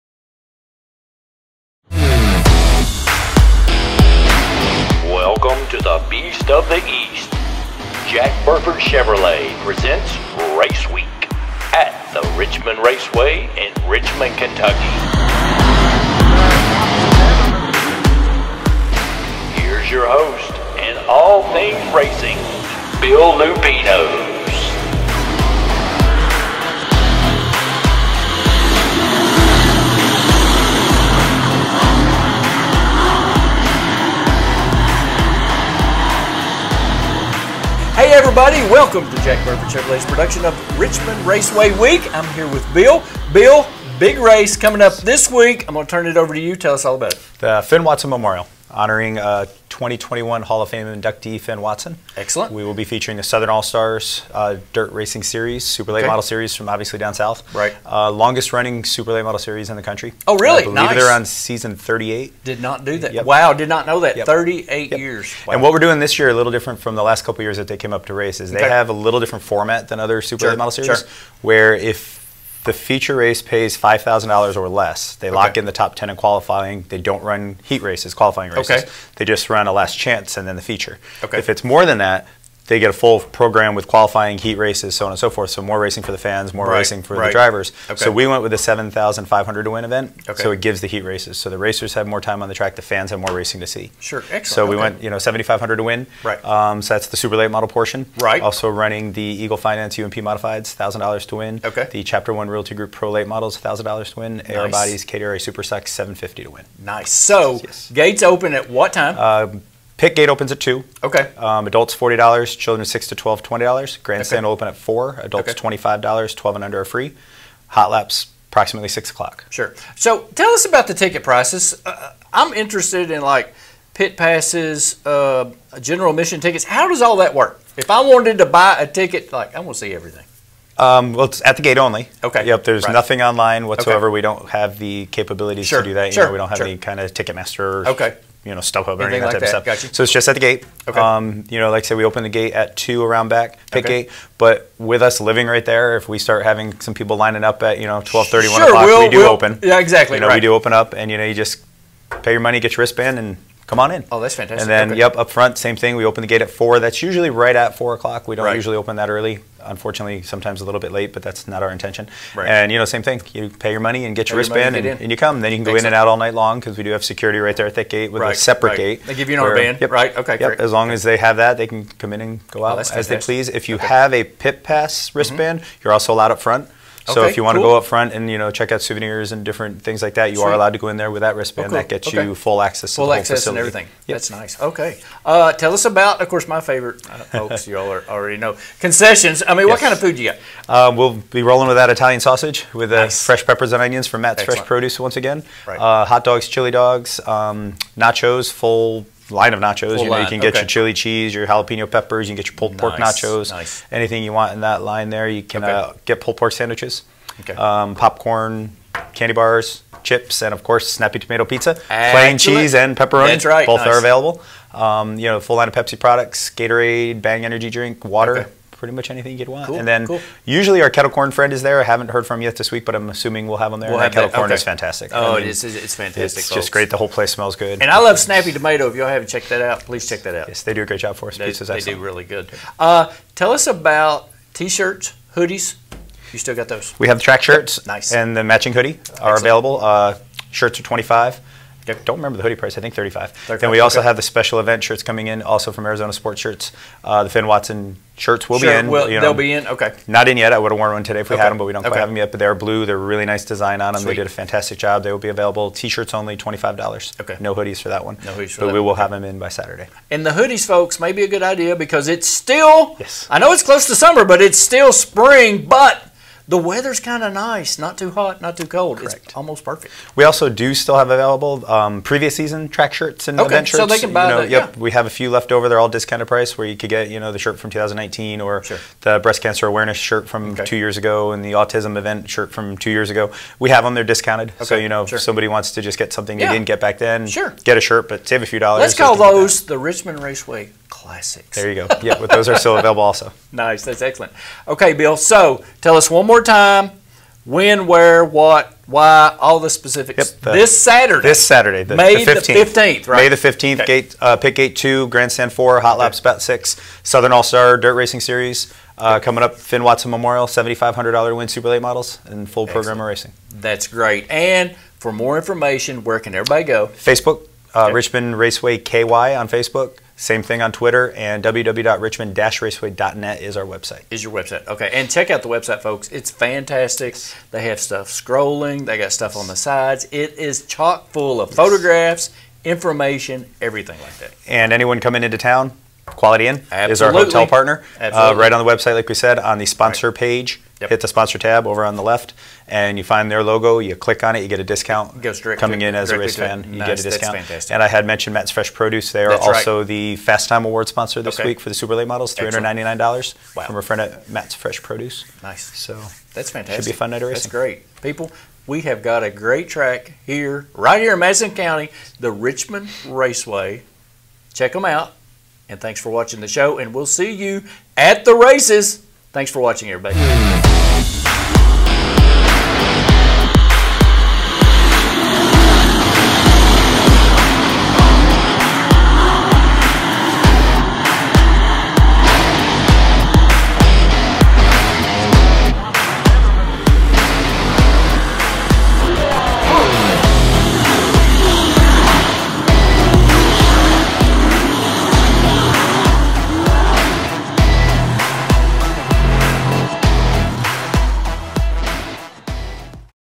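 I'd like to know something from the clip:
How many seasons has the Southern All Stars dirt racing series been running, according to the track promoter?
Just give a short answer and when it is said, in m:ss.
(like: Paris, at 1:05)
38, at 1:01.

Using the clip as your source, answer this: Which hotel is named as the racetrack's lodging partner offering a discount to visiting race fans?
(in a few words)
Quality Inn.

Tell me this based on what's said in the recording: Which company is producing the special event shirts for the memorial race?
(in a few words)
Arizona Sports Shirts.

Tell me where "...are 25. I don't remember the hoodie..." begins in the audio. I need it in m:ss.
4:00.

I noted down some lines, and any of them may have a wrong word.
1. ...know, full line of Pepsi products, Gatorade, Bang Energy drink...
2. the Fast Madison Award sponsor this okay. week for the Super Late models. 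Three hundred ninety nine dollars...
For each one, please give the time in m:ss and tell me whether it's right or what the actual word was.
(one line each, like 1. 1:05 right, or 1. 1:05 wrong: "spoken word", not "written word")
1. 3:35 right
2. 5:49 wrong: "Time", not "Madison".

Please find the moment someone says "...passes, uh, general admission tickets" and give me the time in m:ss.
2:04.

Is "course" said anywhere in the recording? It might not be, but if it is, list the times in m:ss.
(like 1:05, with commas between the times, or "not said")
3:06, 3:30.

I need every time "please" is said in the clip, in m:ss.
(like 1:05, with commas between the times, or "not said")
2:53, 3:49.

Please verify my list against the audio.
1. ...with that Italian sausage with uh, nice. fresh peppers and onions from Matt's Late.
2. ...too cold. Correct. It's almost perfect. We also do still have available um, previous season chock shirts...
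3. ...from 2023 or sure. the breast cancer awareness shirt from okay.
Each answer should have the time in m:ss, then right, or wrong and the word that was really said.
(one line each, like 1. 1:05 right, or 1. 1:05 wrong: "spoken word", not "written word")
1. 3:11 wrong: "Excellent", not "Late"
2. 4:28 wrong: "track", not "chock"
3. 4:37 wrong: "2019", not "2023".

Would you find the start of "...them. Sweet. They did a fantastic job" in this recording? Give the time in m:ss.
4:13.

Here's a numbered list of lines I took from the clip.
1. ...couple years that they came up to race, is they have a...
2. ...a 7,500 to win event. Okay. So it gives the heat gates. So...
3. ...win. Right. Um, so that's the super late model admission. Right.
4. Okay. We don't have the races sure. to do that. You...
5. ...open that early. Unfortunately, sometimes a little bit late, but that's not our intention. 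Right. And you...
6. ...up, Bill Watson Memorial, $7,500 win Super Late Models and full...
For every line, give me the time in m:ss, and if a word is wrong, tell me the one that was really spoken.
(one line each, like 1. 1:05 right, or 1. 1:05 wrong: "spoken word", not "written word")
1. 1:07 right
2. 1:28 wrong: "races", not "gates"
3. 1:35 wrong: "portion", not "admission"
4. 2:14 wrong: "capabilities", not "races"
5. 2:38 right
6. 5:09 wrong: "Finn", not "Bill".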